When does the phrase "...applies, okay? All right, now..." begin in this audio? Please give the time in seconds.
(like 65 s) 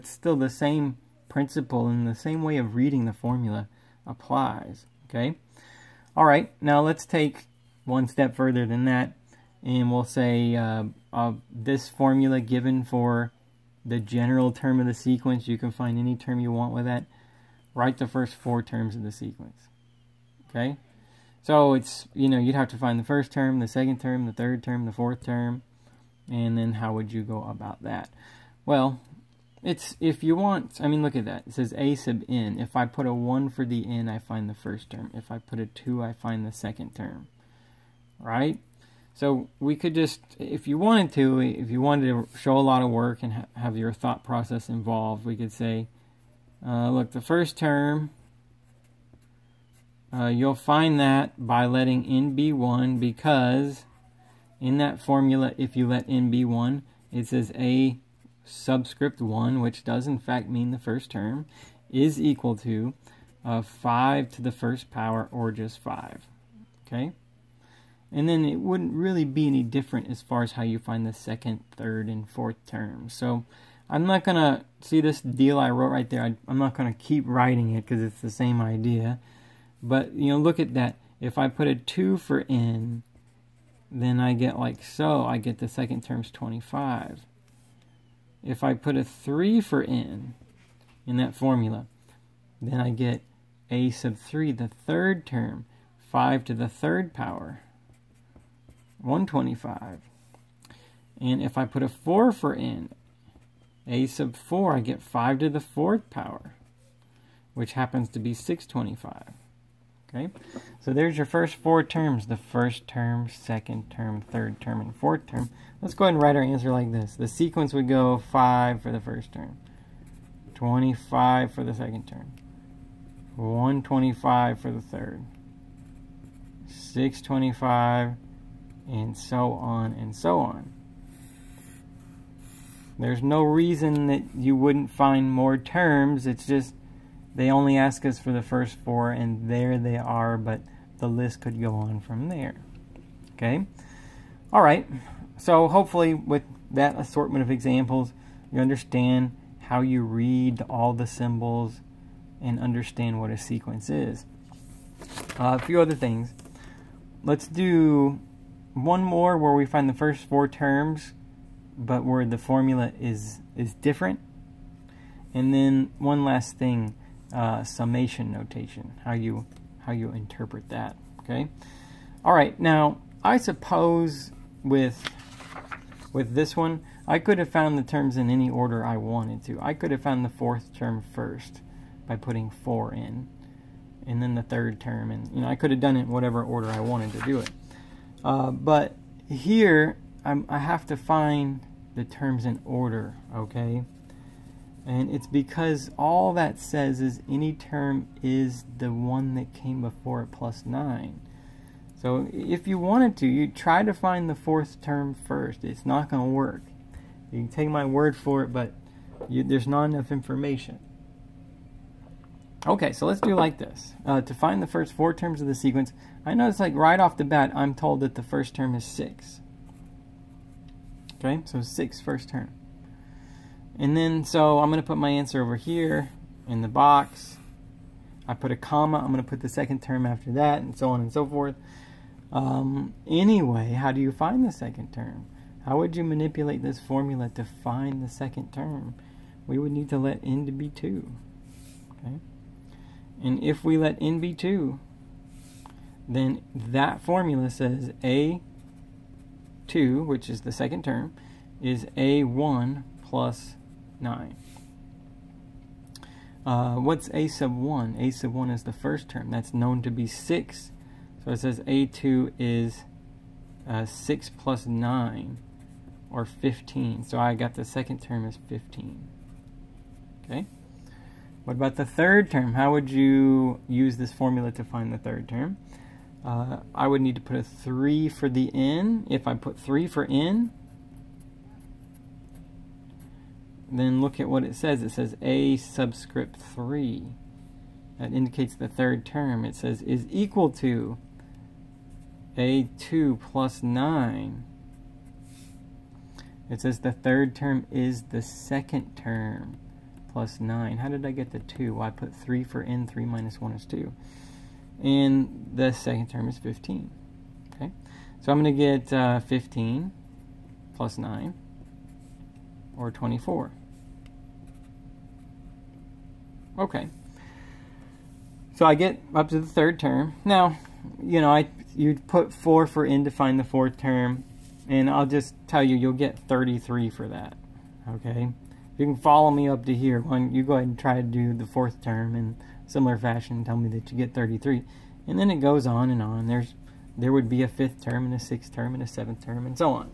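4 s.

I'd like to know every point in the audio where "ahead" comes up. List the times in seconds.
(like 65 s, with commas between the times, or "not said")
116 s, 330 s.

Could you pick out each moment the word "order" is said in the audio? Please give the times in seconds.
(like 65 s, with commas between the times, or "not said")
178 s, 186 s, 192 s.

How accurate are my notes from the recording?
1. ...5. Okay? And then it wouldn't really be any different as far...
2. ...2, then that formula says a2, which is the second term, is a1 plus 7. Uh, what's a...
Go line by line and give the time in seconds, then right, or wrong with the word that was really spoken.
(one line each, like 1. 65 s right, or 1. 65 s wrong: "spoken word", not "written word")
1. 65 s right
2. 244 s wrong: "9", not "7".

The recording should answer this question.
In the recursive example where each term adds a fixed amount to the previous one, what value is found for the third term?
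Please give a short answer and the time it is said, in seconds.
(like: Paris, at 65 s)
24, at 312 s.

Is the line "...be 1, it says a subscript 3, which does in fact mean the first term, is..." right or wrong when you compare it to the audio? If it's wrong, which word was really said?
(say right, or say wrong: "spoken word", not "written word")
wrong: "1", not "3".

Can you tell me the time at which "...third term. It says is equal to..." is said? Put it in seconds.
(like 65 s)
288 s.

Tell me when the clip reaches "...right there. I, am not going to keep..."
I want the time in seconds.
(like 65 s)
75 s.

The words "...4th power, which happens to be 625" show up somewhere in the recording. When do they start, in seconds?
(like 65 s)
105 s.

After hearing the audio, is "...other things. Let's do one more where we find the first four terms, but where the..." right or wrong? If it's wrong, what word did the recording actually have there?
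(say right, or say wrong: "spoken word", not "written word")
right.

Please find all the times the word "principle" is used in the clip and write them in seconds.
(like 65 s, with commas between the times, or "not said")
1 s.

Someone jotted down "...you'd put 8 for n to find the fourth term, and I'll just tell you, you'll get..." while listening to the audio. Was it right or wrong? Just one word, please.
wrong.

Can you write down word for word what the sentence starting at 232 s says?
Um, anyway, how do you find the second term?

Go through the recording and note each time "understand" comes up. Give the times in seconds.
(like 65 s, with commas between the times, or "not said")
148 s, 152 s.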